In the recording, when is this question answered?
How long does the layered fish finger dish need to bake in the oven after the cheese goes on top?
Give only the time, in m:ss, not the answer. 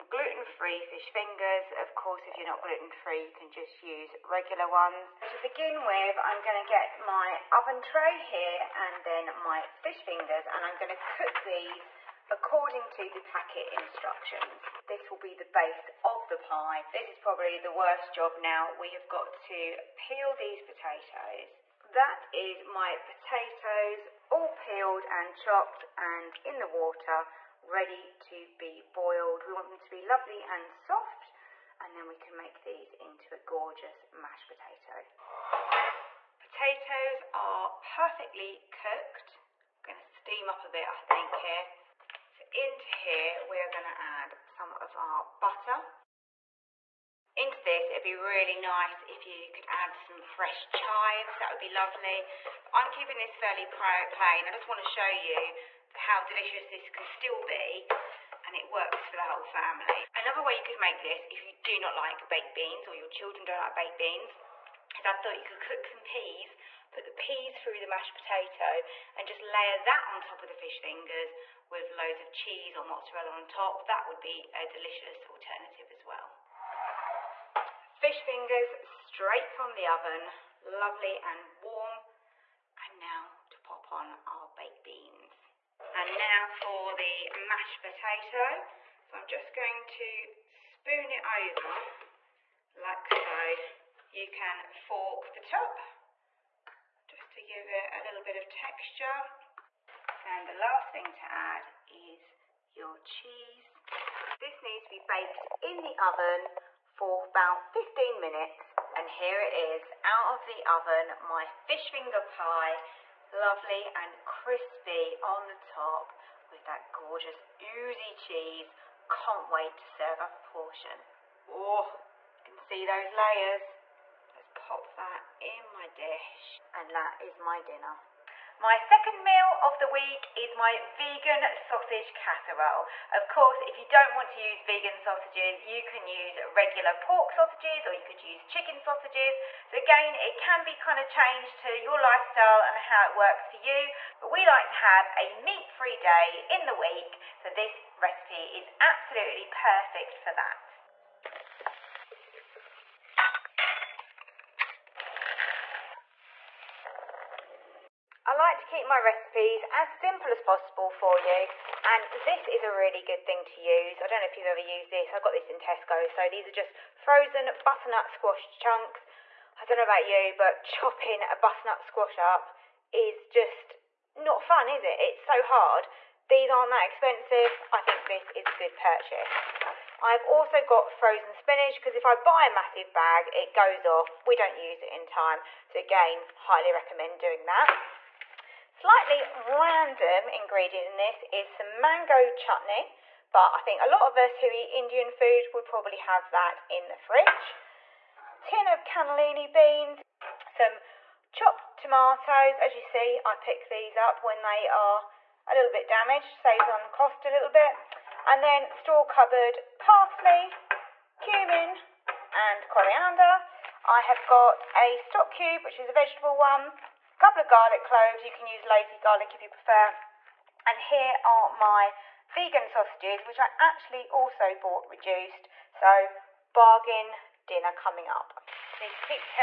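1:47.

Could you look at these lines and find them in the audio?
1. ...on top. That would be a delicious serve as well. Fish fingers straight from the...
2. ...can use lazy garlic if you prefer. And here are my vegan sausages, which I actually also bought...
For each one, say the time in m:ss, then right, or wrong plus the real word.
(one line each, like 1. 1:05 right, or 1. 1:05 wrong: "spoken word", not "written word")
1. 1:13 wrong: "alternative", not "serve"
2. 3:38 right.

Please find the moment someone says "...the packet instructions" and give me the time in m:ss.
0:13.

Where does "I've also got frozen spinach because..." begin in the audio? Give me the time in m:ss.
3:00.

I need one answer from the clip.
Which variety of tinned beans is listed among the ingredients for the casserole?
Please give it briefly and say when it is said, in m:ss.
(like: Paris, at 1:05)
Cannellini beans, at 3:18.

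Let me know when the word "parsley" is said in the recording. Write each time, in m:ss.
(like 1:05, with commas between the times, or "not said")
3:29.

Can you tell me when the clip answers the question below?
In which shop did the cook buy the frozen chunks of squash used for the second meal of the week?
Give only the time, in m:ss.
2:45.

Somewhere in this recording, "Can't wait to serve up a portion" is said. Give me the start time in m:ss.
1:59.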